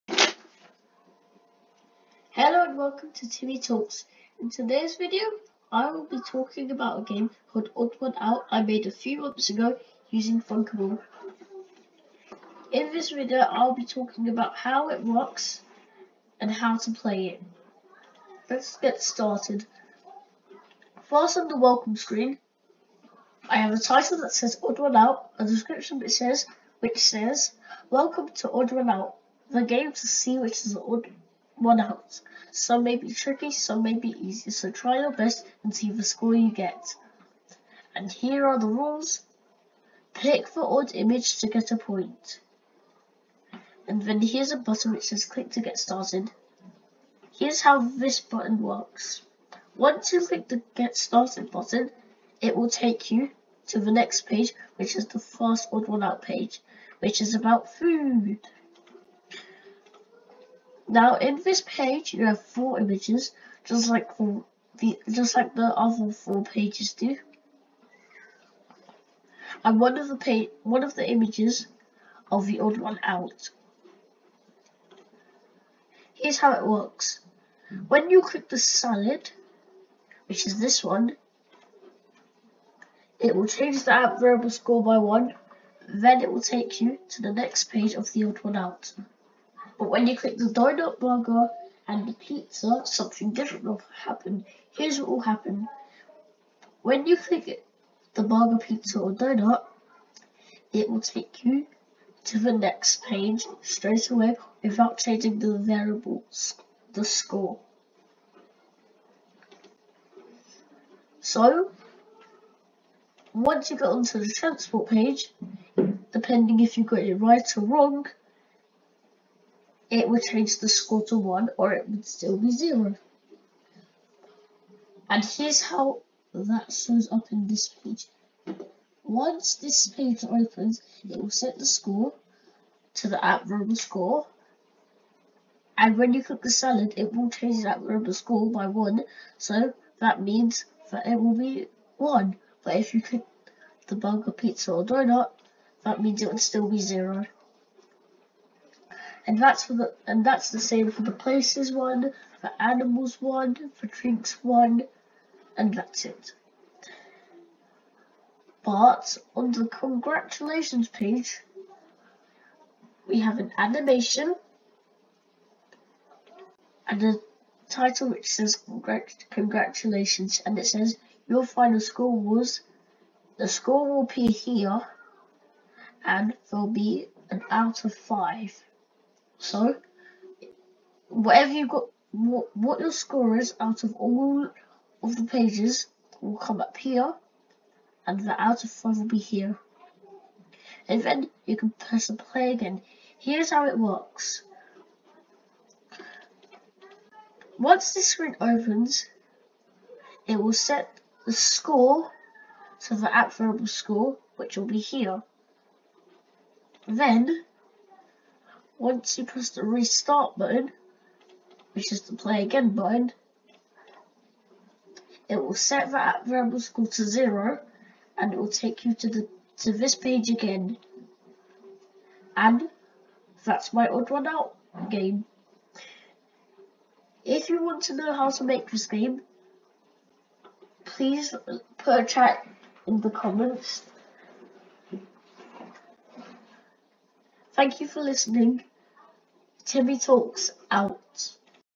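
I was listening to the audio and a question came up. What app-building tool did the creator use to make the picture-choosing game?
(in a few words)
Thunkable.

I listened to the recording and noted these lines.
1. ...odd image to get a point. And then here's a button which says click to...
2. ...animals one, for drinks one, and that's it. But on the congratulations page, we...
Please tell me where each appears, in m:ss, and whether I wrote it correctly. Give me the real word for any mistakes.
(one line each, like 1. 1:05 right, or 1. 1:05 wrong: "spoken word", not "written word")
1. 0:40 right
2. 2:32 right.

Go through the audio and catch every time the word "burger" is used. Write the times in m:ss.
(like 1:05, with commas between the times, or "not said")
1:30, 1:38, 2:23.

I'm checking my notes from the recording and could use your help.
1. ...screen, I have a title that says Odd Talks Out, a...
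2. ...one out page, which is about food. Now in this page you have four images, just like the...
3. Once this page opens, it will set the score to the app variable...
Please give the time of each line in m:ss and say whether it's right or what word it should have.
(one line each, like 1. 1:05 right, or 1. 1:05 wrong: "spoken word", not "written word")
1. 0:21 wrong: "One", not "Talks"
2. 0:55 right
3. 2:09 right.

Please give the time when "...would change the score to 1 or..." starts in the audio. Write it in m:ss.
2:00.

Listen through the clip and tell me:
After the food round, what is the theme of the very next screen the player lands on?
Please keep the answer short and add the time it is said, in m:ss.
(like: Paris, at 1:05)
Transport, at 1:54.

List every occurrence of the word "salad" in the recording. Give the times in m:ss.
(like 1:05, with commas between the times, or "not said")
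1:18, 2:16.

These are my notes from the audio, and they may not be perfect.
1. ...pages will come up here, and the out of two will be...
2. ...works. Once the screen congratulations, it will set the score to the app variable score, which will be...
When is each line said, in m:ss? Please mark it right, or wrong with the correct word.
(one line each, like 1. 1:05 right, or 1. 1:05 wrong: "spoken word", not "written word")
1. 3:05 wrong: "five", not "two"
2. 3:13 wrong: "opens", not "congratulations".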